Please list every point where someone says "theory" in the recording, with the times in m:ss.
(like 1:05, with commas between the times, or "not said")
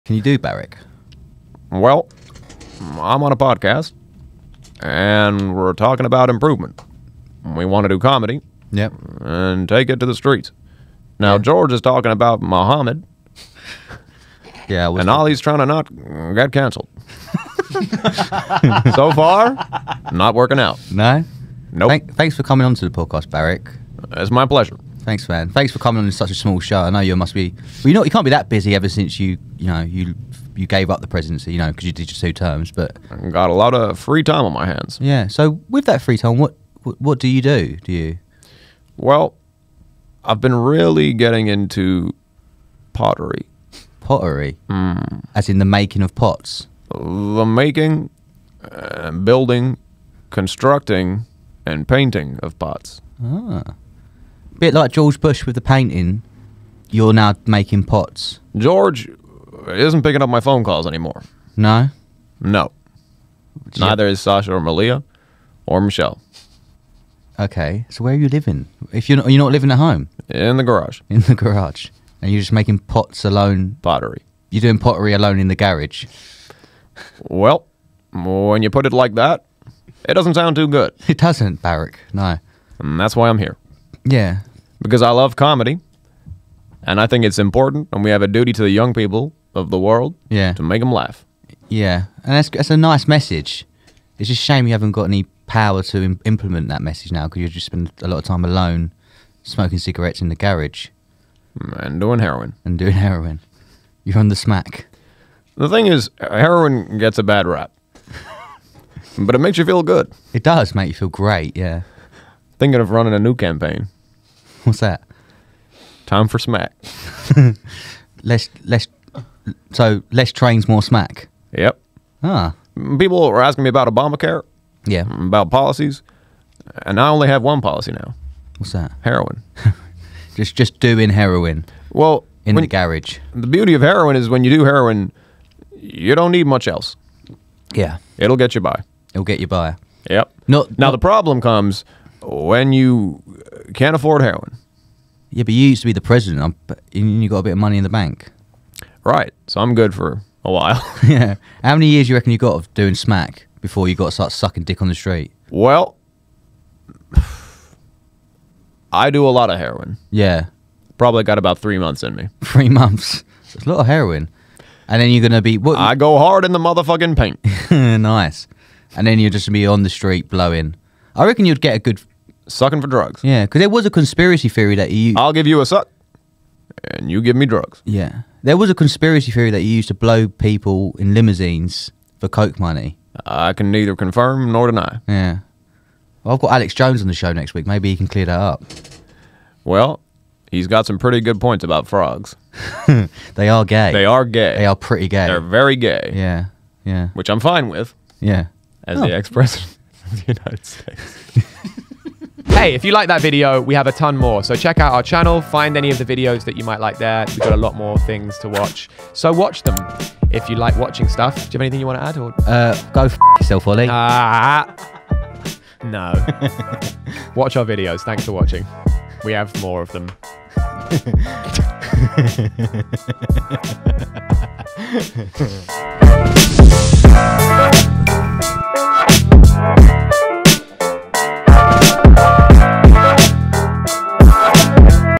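2:54, 2:59.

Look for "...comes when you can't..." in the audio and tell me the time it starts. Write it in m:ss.
2:21.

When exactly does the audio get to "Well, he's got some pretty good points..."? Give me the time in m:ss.
3:09.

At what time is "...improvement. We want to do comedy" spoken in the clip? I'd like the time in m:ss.
0:06.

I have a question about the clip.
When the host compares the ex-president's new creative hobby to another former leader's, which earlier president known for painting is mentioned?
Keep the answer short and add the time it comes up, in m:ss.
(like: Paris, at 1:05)
George Bush, at 0:54.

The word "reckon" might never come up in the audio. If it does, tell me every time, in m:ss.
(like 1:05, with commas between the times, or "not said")
2:32, 2:51.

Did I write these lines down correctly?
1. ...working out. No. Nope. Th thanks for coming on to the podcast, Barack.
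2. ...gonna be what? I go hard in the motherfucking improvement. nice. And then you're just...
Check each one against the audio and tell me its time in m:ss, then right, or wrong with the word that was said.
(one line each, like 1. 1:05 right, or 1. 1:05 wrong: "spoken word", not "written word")
1. 0:20 right
2. 2:45 wrong: "paint", not "improvement".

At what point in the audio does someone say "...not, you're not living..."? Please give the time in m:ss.
1:09.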